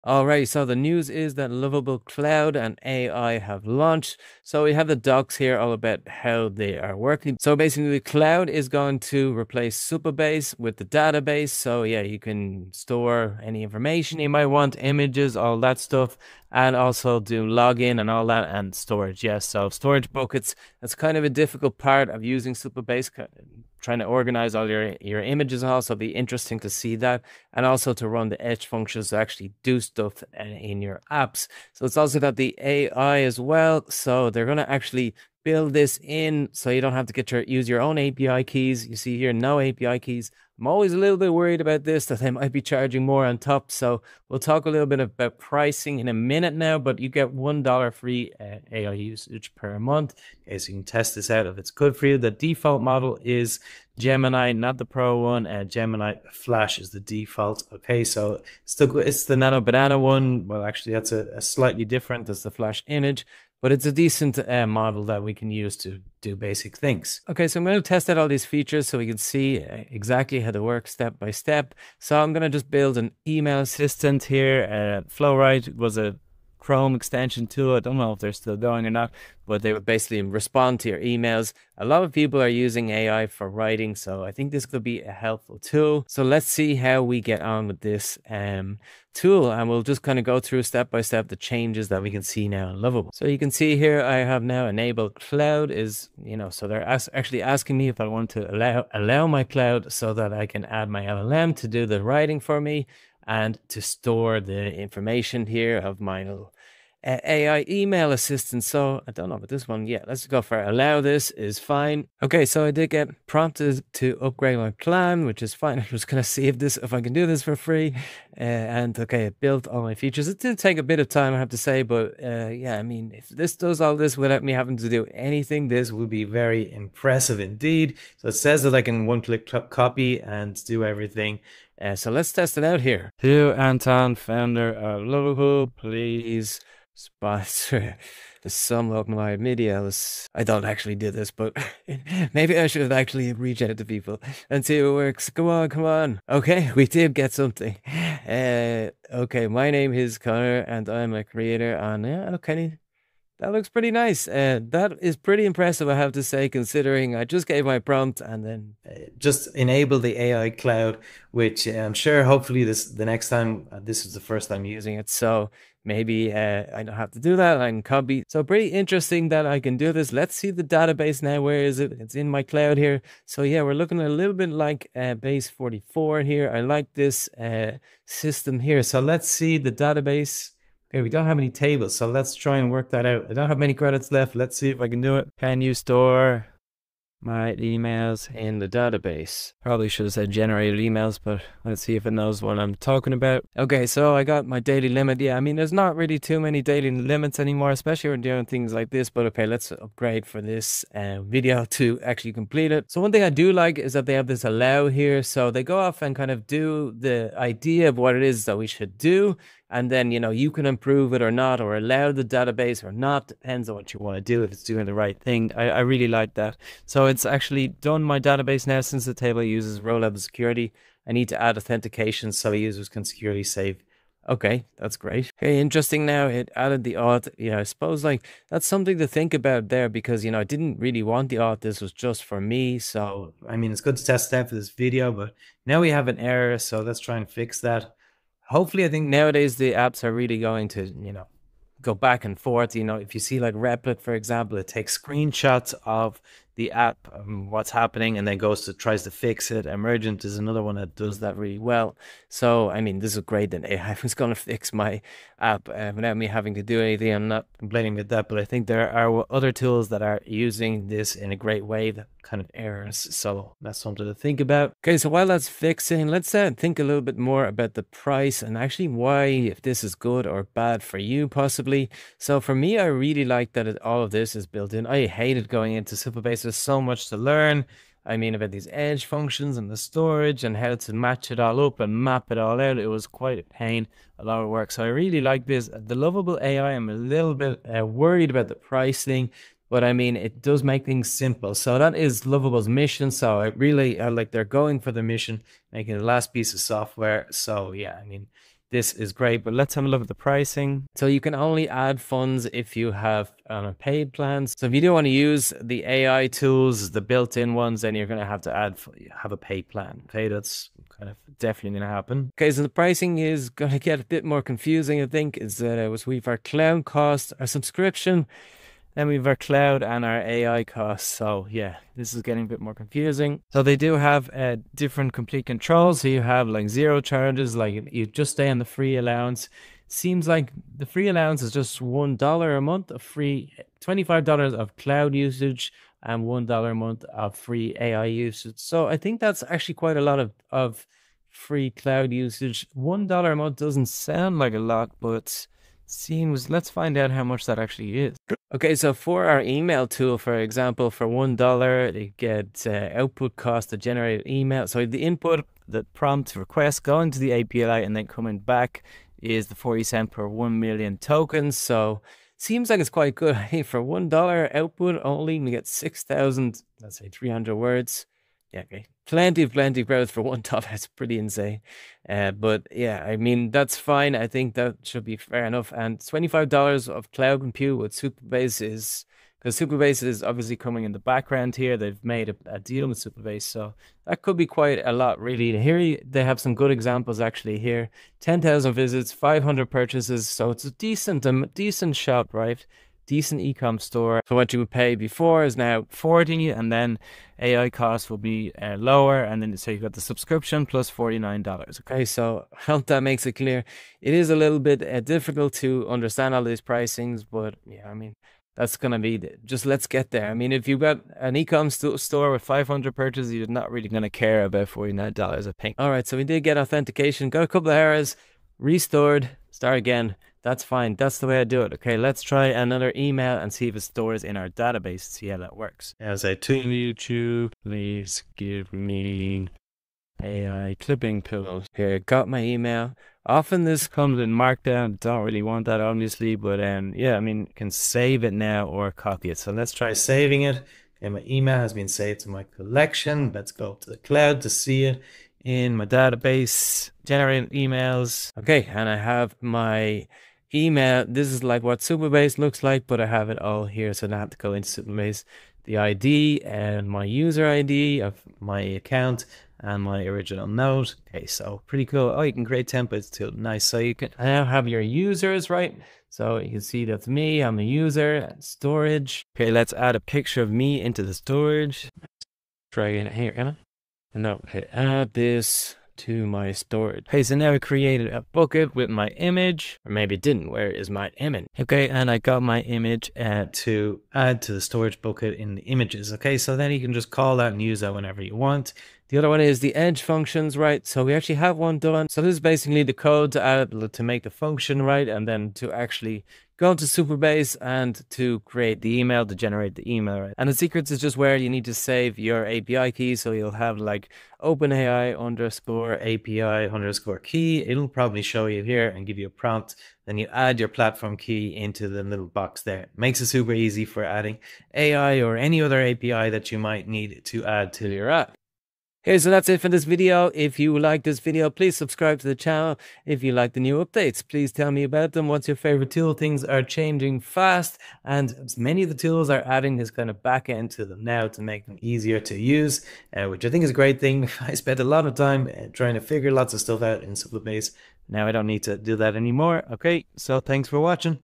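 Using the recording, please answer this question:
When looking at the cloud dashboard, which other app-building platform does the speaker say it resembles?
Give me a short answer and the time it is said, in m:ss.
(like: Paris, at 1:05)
Base44, at 2:55.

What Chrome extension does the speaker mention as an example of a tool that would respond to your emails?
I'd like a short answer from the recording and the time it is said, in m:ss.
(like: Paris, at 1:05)
Flowrite, at 1:15.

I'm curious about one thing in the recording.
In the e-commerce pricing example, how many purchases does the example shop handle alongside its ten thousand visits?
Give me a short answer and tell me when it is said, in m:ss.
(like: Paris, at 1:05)
500, at 6:29.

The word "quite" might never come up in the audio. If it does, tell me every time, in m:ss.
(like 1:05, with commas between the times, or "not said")
4:43, 5:39, 6:02, 6:24.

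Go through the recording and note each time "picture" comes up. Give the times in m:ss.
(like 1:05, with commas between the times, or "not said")
7:49.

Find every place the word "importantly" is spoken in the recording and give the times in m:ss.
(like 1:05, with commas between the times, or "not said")
not said.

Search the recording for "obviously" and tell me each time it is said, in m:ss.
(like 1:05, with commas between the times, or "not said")
6:20, 7:15.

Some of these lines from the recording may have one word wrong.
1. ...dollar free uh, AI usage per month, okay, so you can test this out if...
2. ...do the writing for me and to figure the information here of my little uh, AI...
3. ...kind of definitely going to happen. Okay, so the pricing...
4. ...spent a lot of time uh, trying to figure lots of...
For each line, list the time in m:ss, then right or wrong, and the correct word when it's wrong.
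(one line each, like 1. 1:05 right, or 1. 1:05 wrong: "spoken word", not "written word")
1. 0:47 right
2. 1:41 wrong: "store", not "figure"
3. 5:10 right
4. 8:54 right.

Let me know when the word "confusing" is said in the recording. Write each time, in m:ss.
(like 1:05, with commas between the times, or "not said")
5:14, 5:22.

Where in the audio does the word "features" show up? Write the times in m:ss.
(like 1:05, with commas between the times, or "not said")
1:08, 1:59.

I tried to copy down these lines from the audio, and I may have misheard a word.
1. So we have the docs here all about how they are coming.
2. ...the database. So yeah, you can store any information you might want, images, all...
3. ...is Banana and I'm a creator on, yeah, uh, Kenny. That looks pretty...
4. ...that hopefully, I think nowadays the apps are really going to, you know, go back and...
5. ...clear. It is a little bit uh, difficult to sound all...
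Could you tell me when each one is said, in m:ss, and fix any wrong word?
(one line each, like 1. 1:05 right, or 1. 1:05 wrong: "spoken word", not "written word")
1. 0:04 wrong: "working", not "coming"
2. 0:10 right
3. 2:29 wrong: "Conor", not "Banana"
4. 3:57 right
5. 6:43 wrong: "understand", not "sound".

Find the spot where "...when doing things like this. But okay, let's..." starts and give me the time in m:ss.
3:18.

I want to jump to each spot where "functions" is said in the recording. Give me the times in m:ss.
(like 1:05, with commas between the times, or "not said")
0:28, 4:39, 8:10, 8:14.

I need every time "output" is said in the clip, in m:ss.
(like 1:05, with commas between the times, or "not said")
5:52, 6:04.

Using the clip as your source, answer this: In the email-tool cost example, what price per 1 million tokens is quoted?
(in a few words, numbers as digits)
40 cents.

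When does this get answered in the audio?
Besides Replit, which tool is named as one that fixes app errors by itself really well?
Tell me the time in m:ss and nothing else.
4:09.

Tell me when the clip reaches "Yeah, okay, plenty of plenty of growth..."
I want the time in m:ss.
6:08.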